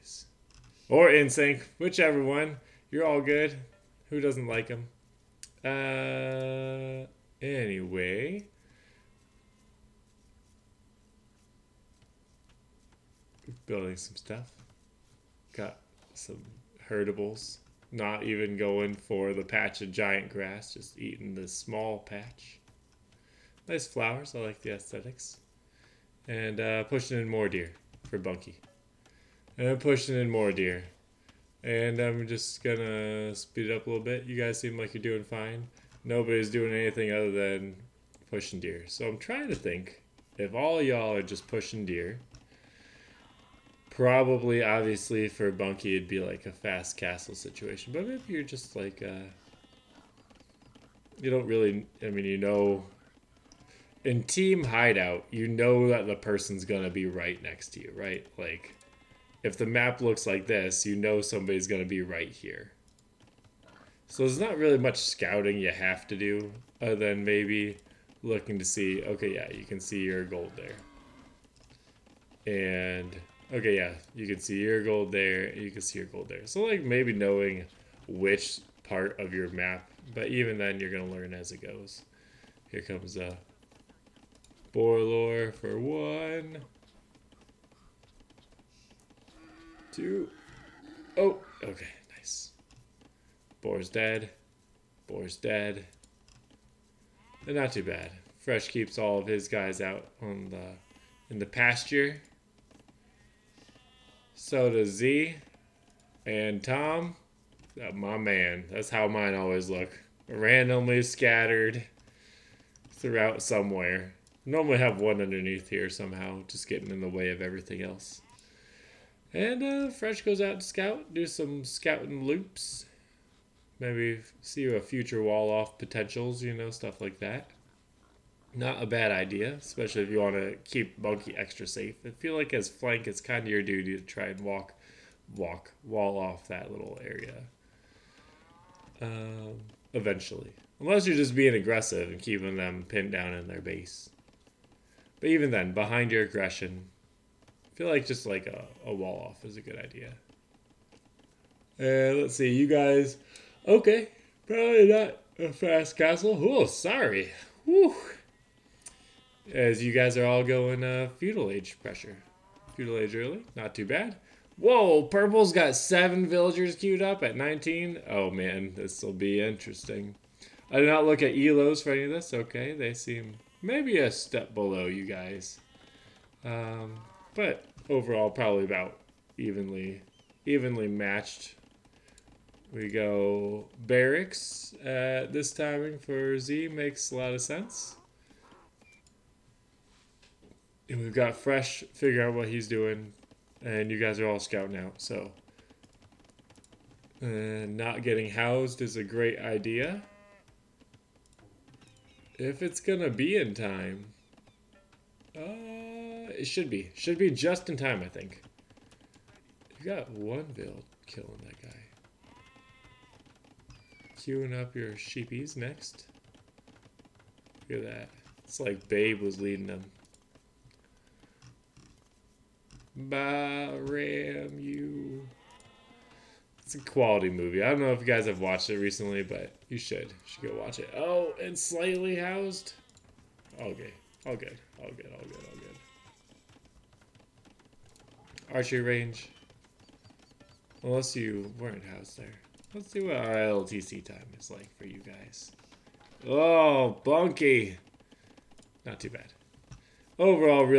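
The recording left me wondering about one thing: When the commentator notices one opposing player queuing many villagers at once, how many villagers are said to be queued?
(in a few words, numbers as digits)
7.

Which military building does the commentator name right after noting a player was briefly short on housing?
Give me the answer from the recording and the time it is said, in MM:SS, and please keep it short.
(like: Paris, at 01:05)
Archery range, at 03:58.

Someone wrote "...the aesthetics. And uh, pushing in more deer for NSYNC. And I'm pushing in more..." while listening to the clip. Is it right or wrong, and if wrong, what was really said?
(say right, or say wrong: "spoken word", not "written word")
wrong: "Bunky", not "NSYNC".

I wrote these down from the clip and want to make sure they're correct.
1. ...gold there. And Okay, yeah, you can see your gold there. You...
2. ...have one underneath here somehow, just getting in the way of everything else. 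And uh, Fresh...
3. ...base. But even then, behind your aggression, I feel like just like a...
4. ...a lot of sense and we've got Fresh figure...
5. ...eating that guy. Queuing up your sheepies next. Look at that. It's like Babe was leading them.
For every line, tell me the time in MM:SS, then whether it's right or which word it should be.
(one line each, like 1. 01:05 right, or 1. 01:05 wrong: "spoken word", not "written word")
1. 01:10 right
2. 01:54 right
3. 02:23 right
4. 03:07 right
5. 03:31 wrong: "killing", not "eating".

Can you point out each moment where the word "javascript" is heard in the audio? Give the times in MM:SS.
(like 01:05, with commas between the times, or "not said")
not said.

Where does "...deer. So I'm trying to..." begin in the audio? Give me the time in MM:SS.
00:38.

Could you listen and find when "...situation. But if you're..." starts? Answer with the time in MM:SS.
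00:47.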